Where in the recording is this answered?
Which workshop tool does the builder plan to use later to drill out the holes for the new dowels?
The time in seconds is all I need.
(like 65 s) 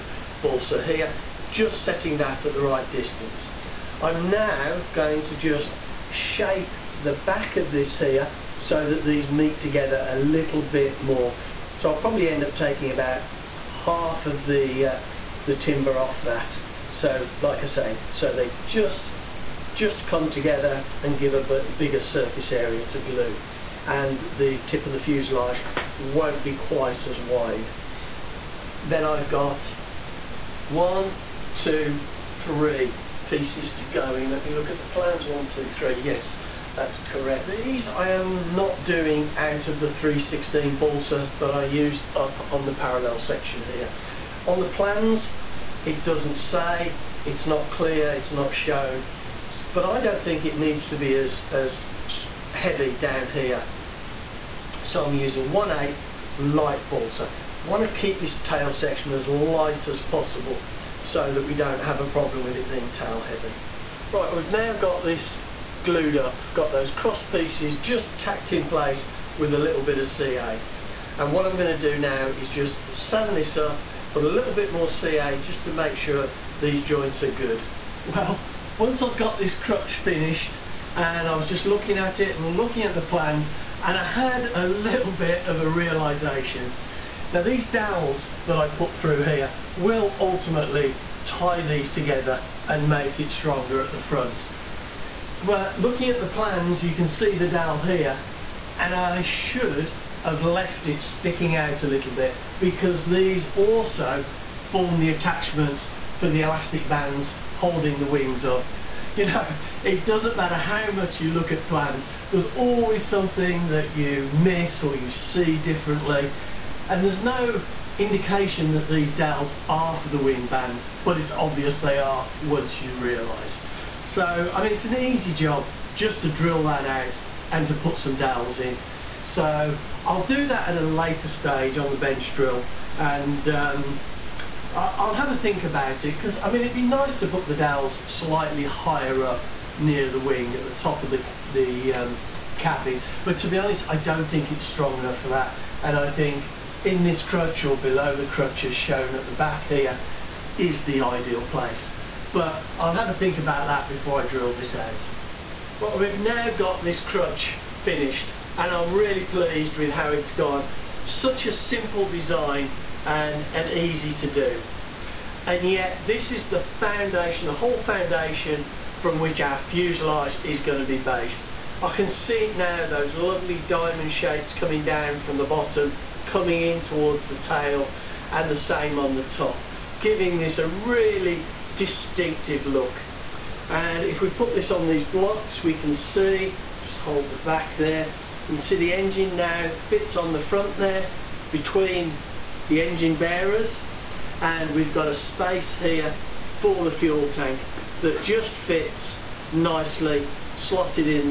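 131 s.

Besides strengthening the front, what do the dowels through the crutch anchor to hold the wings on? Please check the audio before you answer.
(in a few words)
Elastic bands.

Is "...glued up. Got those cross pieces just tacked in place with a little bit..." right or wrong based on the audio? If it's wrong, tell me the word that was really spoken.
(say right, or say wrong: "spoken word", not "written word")
right.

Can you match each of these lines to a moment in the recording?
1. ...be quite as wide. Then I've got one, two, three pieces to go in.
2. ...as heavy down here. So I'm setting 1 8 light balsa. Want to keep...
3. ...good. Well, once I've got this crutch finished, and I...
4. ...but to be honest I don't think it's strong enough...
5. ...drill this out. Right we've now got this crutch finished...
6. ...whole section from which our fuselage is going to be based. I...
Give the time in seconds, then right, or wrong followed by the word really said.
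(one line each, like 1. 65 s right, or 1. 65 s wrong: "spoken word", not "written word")
1. 26 s right
2. 51 s wrong: "using", not "setting"
3. 77 s right
4. 143 s right
5. 154 s right
6. 167 s wrong: "foundation", not "section".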